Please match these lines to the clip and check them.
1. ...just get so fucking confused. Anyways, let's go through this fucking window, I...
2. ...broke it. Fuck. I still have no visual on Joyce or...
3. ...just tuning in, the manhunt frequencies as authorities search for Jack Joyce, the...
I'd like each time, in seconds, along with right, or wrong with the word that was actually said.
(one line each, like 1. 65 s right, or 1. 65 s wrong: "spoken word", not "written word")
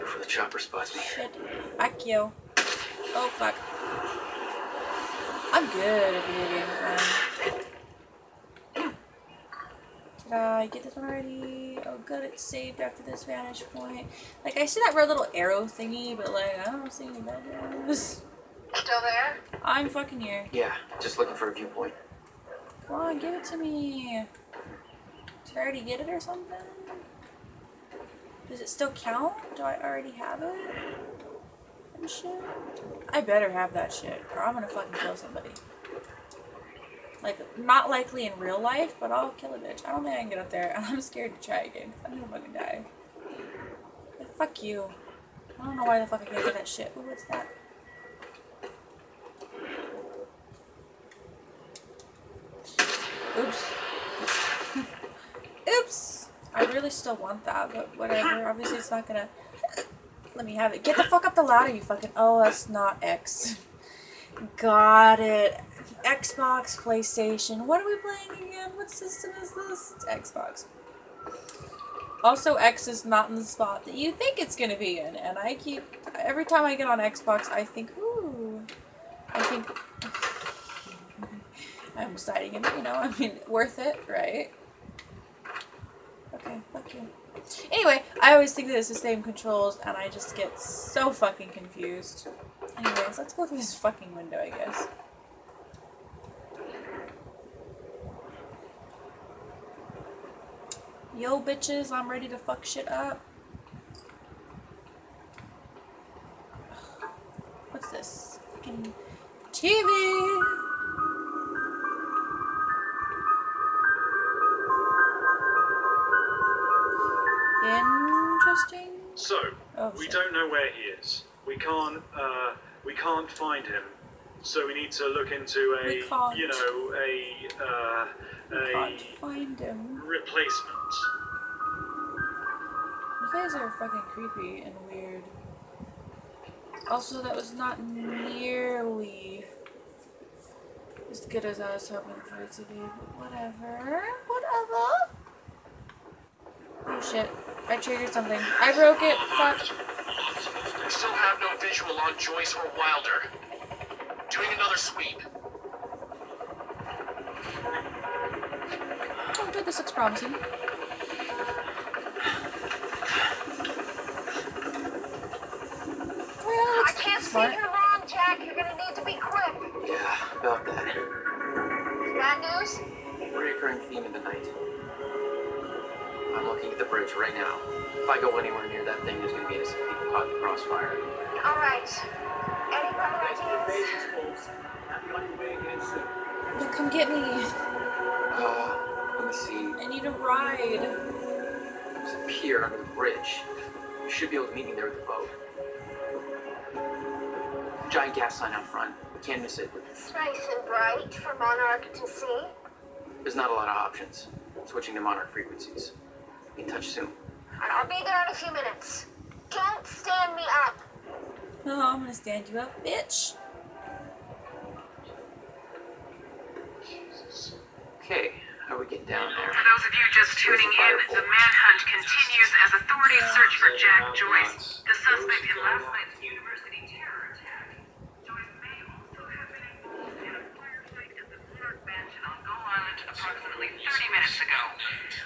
1. 90 s right
2. 148 s right
3. 220 s wrong: "continues", not "frequencies".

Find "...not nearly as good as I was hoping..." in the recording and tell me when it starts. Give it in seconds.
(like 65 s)
137 s.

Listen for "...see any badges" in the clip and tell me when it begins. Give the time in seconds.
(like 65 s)
16 s.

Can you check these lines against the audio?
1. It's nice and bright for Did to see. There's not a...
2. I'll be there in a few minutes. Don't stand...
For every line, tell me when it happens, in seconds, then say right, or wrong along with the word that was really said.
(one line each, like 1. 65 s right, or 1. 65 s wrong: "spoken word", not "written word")
1. 199 s wrong: "Monarch", not "Did"
2. 207 s right.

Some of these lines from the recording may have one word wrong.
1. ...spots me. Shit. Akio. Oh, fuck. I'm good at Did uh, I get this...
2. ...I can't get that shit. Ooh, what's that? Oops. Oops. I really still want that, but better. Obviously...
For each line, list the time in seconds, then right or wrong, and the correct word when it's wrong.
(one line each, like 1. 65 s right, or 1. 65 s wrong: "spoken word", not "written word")
1. 0 s right
2. 46 s wrong: "whatever", not "better".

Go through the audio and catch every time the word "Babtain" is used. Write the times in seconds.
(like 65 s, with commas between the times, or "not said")
not said.